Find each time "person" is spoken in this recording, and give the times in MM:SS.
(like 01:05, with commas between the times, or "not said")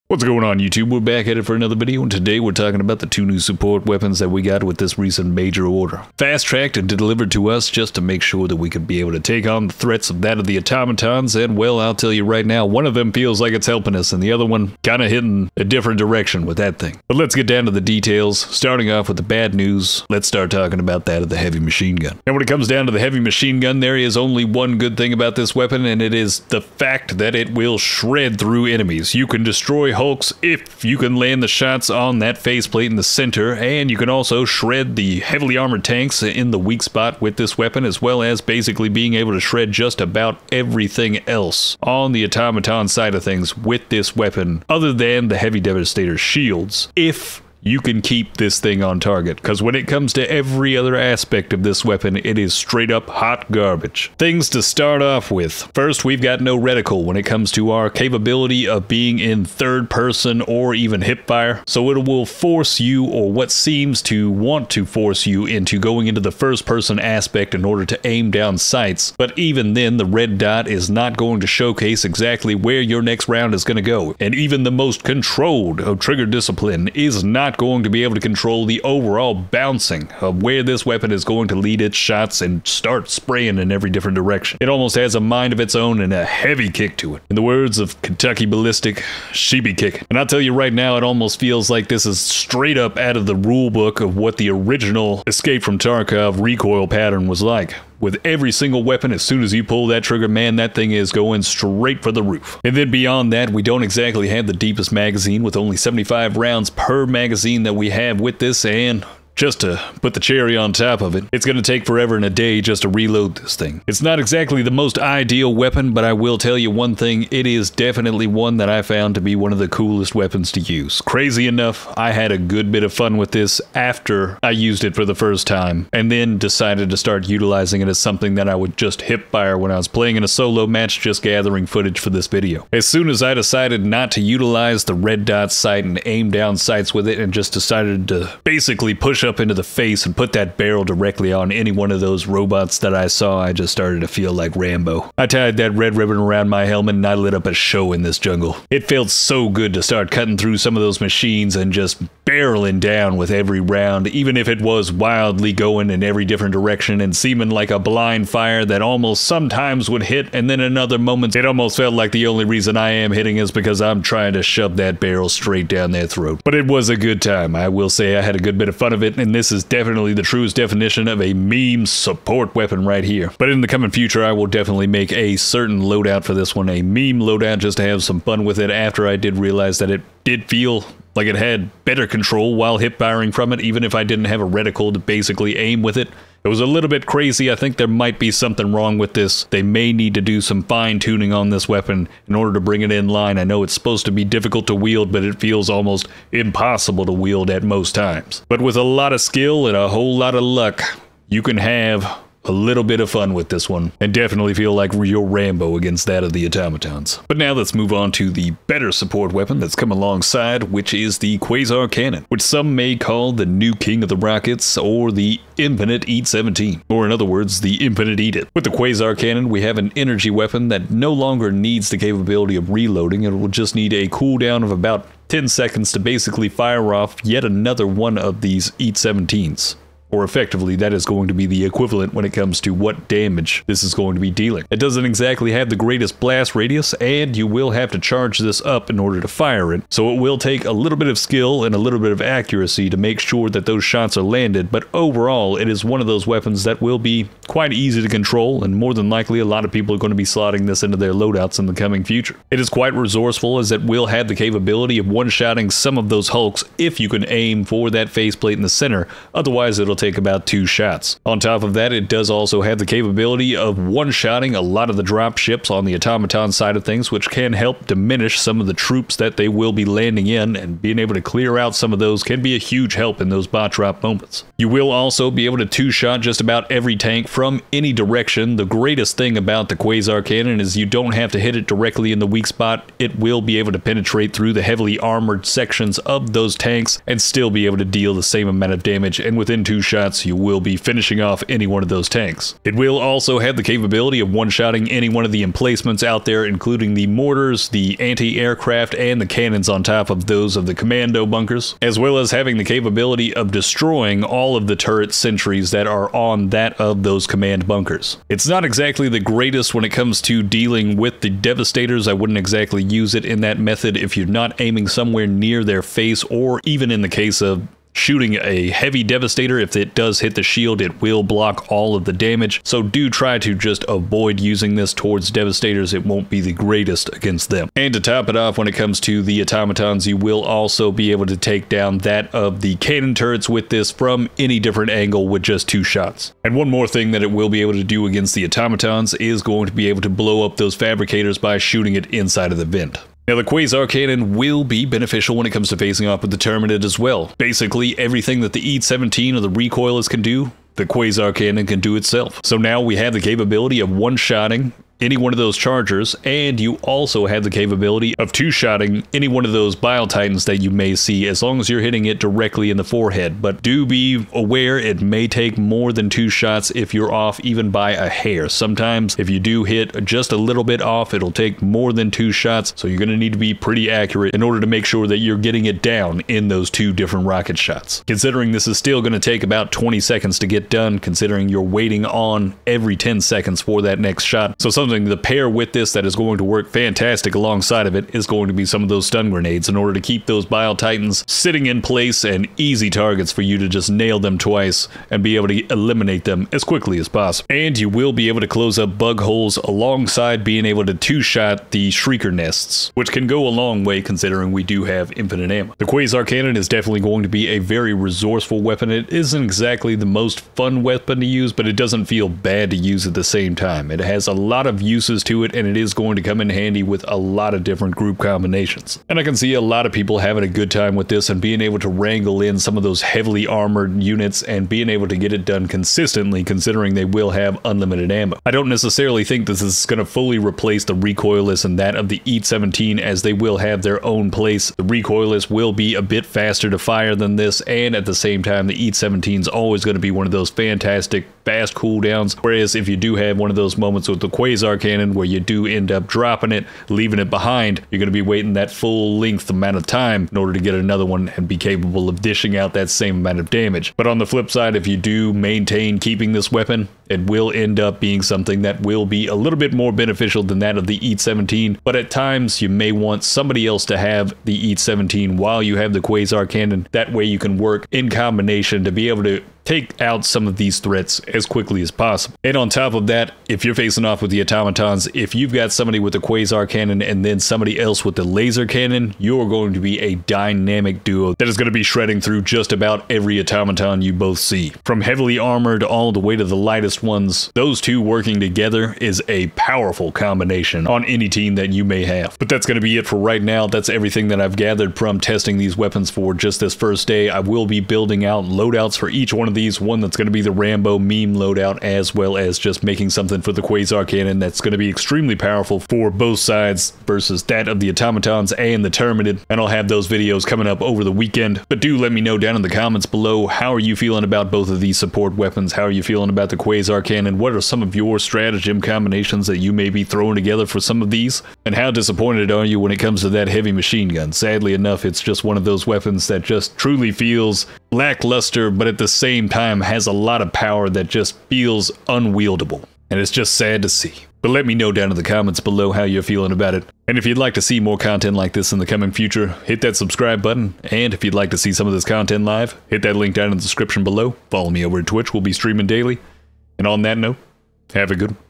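00:59, 01:06.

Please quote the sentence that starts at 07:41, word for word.
But at times, you may want somebody else to have the EAT 17 while you have the Quasar Cannon.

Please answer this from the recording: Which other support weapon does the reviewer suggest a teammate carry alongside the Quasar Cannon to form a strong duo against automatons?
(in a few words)
Laser cannon.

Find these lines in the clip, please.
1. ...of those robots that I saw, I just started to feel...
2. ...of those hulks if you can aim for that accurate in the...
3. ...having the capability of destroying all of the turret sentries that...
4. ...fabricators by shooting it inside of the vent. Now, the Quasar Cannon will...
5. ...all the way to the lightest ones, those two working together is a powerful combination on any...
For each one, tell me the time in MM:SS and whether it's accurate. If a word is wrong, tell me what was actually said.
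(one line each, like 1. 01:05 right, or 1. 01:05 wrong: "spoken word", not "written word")
1. 02:21 right
2. 04:15 wrong: "faceplate", not "accurate"
3. 05:02 right
4. 05:40 right
5. 08:05 right.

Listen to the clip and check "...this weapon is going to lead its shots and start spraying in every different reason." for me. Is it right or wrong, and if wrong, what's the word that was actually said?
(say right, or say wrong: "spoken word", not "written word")
wrong: "direction", not "reason".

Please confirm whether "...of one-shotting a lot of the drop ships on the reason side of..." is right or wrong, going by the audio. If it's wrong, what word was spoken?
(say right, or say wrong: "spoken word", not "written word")
wrong: "automaton", not "reason".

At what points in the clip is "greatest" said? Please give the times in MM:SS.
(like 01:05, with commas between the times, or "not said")
03:55, 04:38, 05:09, 05:26.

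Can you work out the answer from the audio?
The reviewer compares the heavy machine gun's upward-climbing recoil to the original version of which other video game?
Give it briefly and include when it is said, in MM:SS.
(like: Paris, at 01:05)
Escape from Tarkov, at 01:35.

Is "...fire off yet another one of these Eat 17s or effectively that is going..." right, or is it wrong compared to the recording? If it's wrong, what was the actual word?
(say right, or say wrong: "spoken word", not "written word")
right.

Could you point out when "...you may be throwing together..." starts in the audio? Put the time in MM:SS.
08:39.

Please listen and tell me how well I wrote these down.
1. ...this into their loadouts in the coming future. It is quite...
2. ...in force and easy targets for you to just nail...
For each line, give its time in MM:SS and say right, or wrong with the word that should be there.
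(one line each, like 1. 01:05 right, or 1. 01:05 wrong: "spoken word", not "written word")
1. 04:10 right
2. 06:31 wrong: "place", not "force".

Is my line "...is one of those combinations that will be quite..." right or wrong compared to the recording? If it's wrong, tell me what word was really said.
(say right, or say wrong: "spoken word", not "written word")
wrong: "weapons", not "combinations".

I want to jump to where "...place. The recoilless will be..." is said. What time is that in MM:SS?
07:14.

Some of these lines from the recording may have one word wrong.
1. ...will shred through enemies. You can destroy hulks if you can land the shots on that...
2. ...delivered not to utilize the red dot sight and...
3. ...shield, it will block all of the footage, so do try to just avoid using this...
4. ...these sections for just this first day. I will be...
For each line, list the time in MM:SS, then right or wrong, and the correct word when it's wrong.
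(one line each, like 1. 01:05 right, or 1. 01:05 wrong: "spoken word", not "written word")
1. 00:27 right
2. 02:13 wrong: "decided", not "delivered"
3. 05:20 wrong: "damage", not "footage"
4. 08:15 wrong: "weapons", not "sections".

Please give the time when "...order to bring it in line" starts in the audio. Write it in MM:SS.
03:12.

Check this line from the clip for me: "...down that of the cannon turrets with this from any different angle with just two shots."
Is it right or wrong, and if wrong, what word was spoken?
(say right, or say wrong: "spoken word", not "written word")
right.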